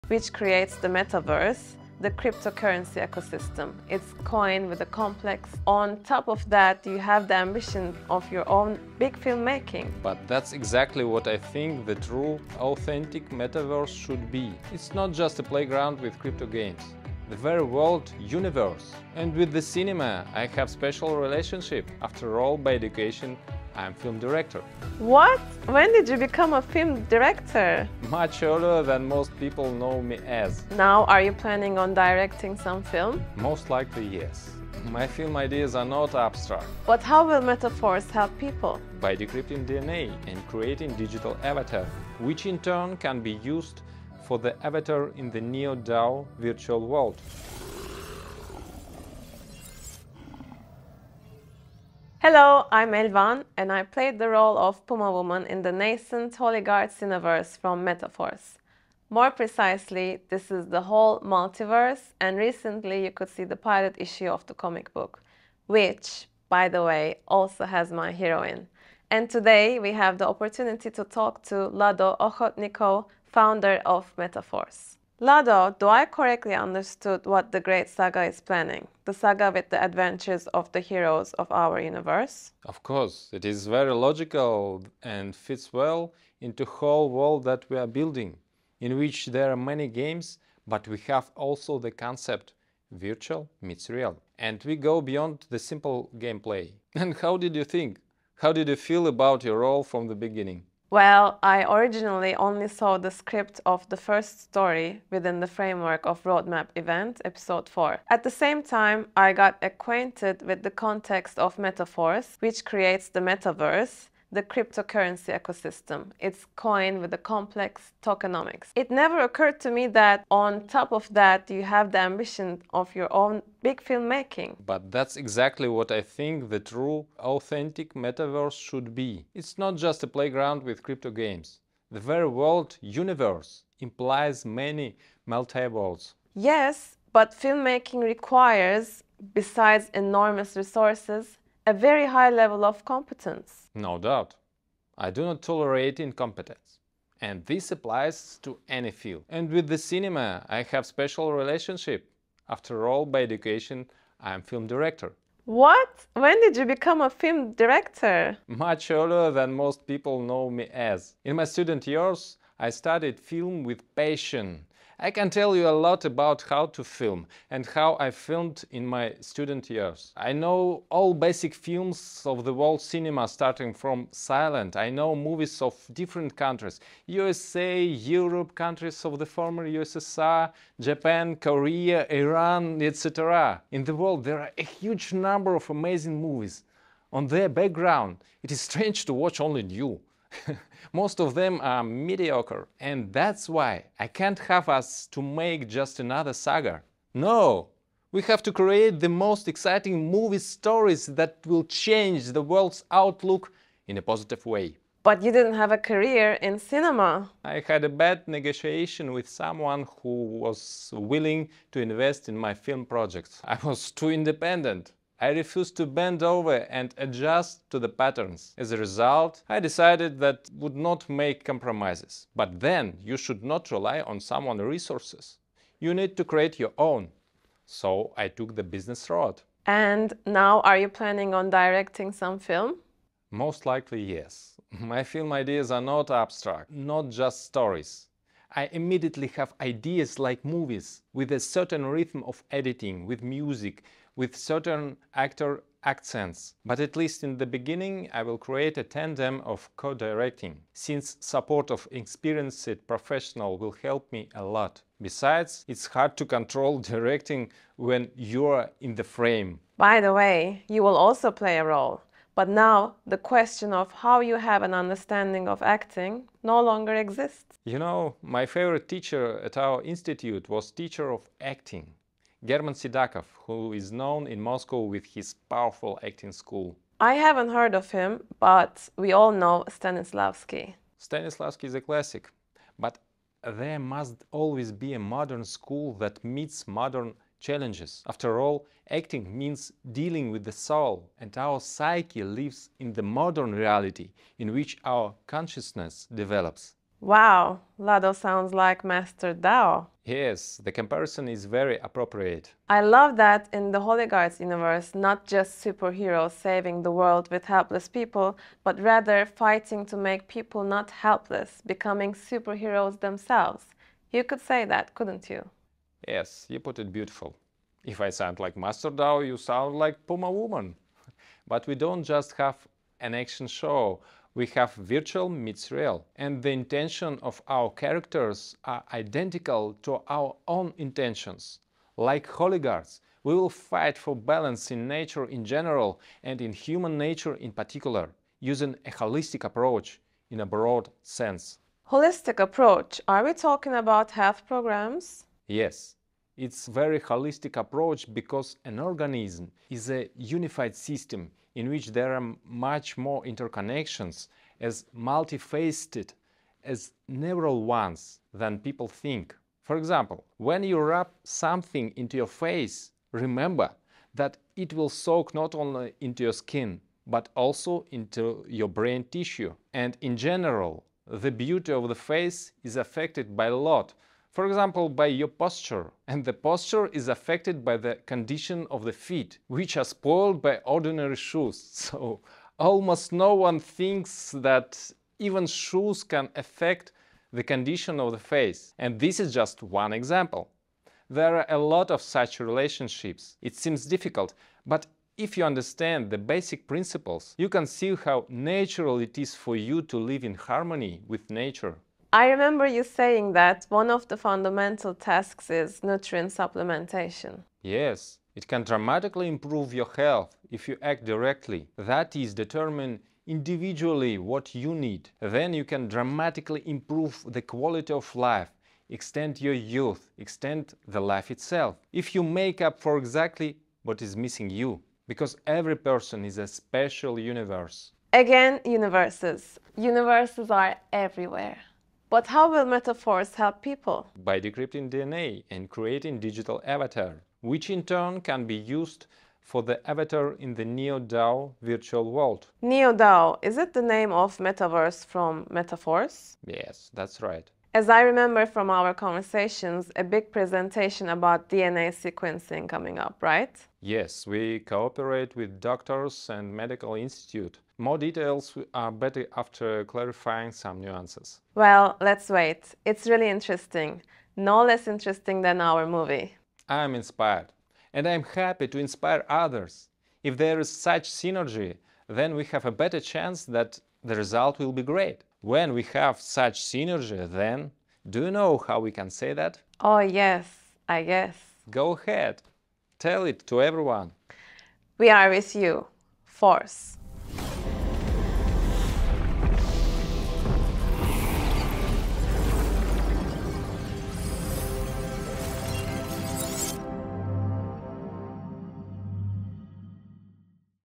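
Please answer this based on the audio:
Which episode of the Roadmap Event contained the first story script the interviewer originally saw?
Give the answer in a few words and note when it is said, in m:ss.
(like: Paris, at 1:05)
Episode 4, at 1:47.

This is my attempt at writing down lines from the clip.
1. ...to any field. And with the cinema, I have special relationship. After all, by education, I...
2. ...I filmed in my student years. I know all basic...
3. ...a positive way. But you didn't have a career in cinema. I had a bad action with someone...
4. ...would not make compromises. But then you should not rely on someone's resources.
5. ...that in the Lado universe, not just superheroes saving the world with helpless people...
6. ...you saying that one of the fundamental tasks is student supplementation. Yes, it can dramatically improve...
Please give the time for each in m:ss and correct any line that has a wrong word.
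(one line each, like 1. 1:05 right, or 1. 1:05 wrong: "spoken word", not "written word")
1. 2:28 right
2. 2:47 right
3. 3:23 wrong: "negotiation", not "action"
4. 3:40 right
5. 5:03 wrong: "Holiguards", not "Lado"
6. 6:42 wrong: "nutrient", not "student".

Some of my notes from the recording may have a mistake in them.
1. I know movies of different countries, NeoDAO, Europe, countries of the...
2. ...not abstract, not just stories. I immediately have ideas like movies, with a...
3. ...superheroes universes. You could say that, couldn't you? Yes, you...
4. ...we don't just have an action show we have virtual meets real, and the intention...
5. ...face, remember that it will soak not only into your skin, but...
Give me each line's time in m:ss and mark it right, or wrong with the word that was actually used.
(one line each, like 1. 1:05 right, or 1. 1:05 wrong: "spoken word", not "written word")
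1. 2:54 wrong: "USA", not "NeoDAO"
2. 3:55 right
3. 5:12 wrong: "themselves", not "universes"
4. 5:21 right
5. 6:02 right.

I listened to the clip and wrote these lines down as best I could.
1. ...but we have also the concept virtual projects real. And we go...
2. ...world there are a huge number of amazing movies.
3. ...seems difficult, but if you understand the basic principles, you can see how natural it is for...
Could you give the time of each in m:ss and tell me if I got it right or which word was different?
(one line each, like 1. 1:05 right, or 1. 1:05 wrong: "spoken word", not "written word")
1. 1:30 wrong: "meets", not "projects"
2. 3:03 right
3. 6:33 right.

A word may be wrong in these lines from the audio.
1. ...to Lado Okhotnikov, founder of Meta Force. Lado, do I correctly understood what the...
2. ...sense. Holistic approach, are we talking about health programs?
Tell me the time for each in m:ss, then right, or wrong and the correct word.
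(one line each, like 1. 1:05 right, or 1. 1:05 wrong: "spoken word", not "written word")
1. 1:11 right
2. 5:41 right.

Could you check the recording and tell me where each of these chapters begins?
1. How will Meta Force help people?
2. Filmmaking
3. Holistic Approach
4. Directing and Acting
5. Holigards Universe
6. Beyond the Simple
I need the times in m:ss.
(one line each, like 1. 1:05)
1. 7:07
2. 2:16
3. 5:42
4. 3:50
5. 4:56
6. 0:51.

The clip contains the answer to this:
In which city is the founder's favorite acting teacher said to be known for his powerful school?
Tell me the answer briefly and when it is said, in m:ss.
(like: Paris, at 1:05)
Moscow, at 4:34.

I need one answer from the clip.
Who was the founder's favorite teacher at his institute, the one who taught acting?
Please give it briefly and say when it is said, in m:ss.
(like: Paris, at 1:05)
German Sidakov, at 4:32.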